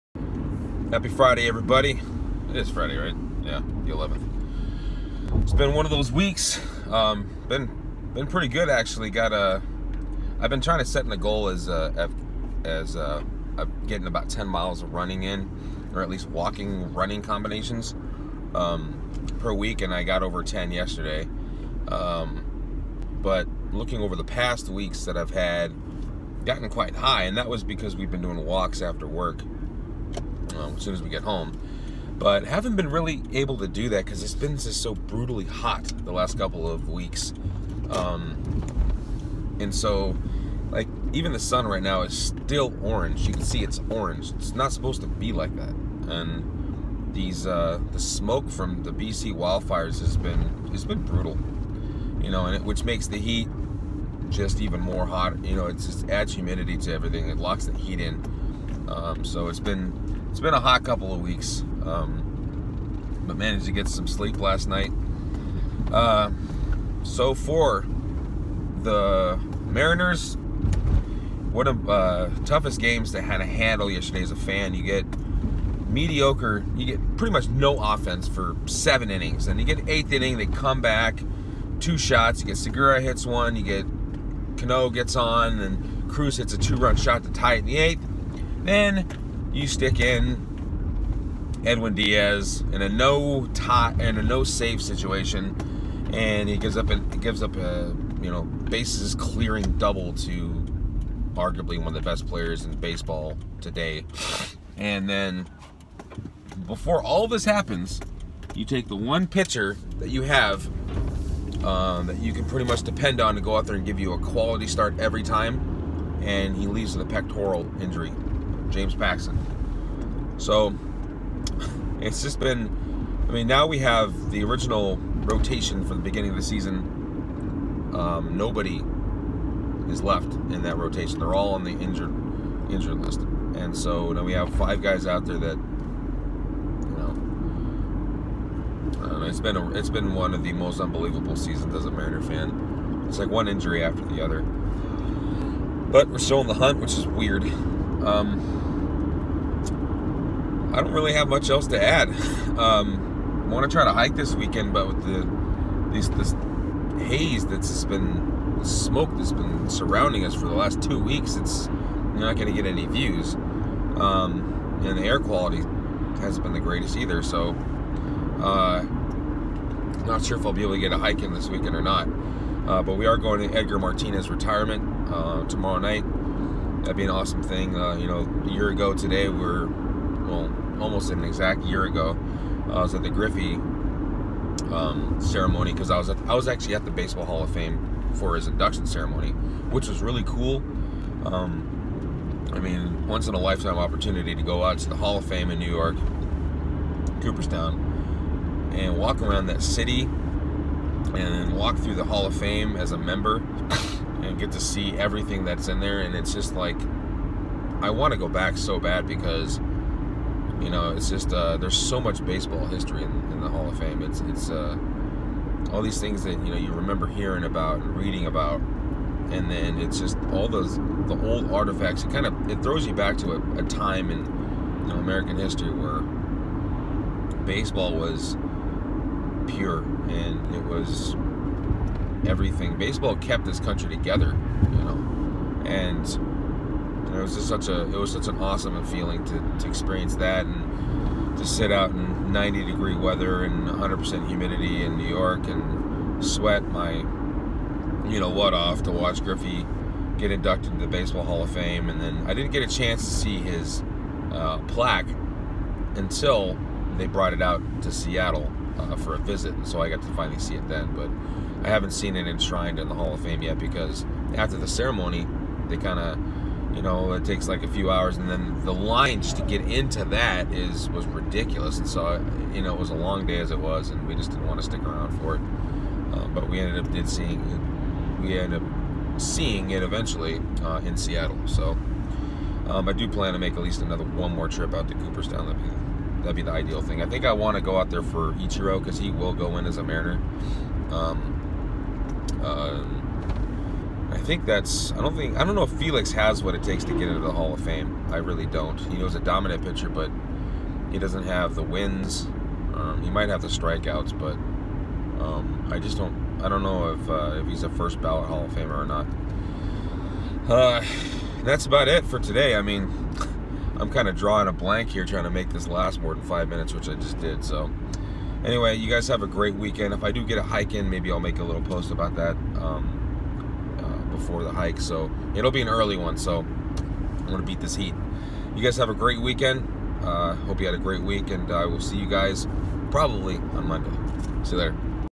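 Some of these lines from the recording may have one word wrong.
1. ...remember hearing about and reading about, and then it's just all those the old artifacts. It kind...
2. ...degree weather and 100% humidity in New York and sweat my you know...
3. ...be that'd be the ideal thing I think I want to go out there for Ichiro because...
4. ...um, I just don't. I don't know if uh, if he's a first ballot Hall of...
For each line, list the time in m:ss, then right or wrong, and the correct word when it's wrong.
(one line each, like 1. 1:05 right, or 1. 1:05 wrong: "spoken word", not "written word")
1. 3:36 right
2. 4:02 right
3. 4:45 right
4. 5:05 right.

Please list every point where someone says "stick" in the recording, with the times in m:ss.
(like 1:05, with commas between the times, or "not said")
1:29, 4:34.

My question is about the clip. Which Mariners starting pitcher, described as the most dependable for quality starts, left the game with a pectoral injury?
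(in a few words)
James Paxton.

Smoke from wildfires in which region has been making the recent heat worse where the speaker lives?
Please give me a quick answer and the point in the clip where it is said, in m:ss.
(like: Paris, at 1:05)
BC, at 0:48.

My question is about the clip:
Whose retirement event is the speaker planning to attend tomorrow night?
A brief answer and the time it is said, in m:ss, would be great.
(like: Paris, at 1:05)
Edgar Martinez, at 2:53.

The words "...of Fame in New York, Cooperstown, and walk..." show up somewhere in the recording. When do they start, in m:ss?
3:15.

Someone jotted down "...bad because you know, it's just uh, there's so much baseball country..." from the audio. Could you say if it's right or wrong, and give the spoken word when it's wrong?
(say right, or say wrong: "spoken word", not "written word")
wrong: "history", not "country".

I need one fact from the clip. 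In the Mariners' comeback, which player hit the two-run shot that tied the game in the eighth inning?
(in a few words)
Cruz.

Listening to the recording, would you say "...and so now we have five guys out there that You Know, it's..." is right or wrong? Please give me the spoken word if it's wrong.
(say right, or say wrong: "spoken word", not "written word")
right.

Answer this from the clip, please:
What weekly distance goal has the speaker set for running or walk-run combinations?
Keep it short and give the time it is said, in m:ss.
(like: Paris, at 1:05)
10 miles, at 0:14.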